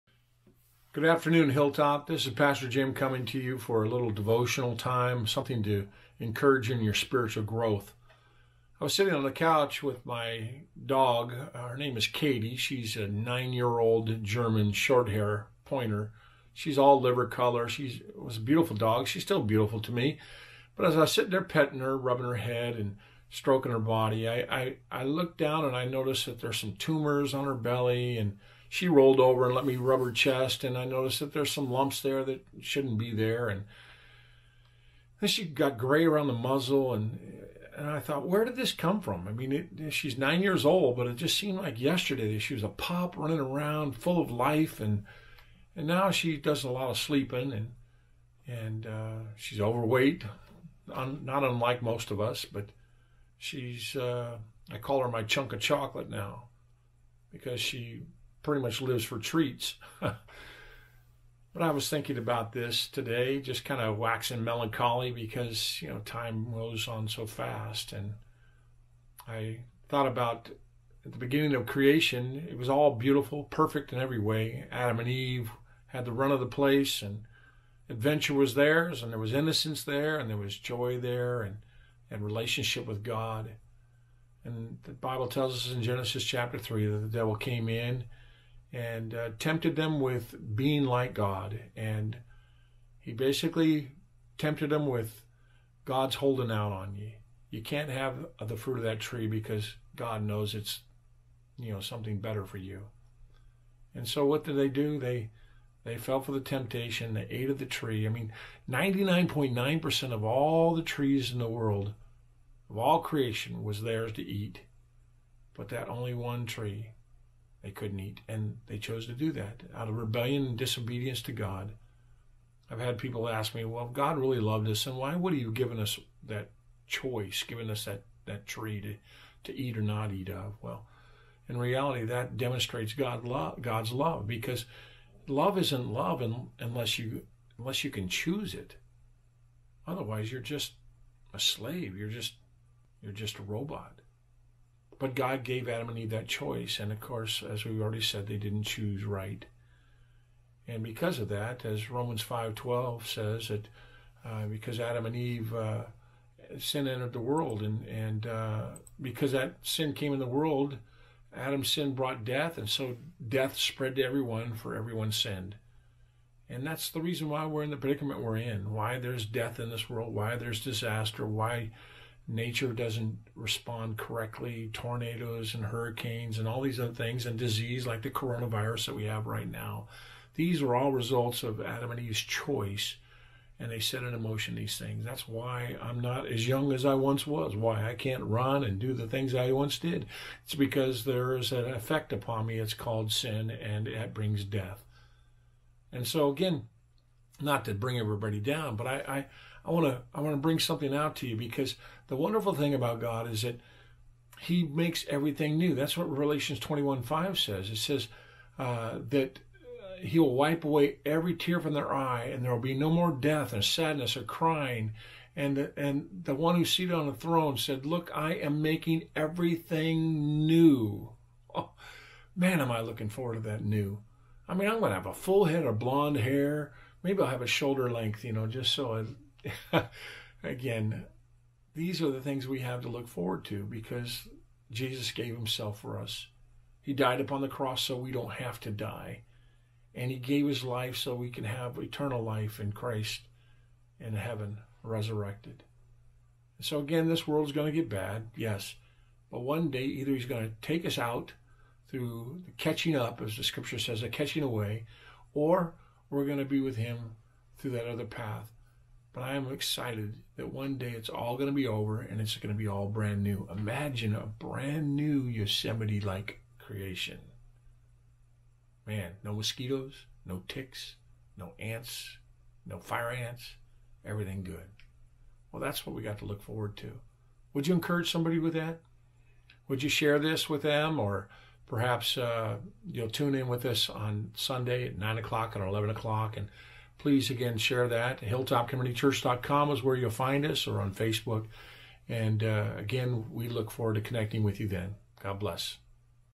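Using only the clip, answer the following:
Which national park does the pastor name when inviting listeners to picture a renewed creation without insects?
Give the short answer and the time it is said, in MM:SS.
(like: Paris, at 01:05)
Yosemite, at 04:25.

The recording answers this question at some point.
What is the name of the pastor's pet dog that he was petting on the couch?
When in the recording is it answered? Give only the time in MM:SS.
00:12.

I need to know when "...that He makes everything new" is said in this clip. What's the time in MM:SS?
03:23.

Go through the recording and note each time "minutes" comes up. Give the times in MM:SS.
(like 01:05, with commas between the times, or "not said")
not said.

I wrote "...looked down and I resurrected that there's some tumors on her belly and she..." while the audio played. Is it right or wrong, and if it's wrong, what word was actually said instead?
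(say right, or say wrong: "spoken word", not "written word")
wrong: "noticed", not "resurrected".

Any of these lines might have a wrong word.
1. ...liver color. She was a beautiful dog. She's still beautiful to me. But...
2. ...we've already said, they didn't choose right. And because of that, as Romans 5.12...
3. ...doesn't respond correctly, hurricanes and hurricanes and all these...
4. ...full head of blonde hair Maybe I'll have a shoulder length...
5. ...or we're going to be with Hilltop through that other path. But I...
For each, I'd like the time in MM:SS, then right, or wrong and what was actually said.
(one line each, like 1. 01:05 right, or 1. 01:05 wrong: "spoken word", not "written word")
1. 00:16 right
2. 02:27 right
3. 02:52 wrong: "tornadoes", not "hurricanes"
4. 03:45 right
5. 04:15 wrong: "Him", not "Hilltop".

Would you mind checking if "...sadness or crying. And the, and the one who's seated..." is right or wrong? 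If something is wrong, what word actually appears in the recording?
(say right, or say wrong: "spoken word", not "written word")
right.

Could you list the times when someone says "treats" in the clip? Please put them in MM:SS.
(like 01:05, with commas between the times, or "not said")
00:59.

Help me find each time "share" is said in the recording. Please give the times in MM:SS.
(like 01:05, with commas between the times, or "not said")
04:39, 04:47.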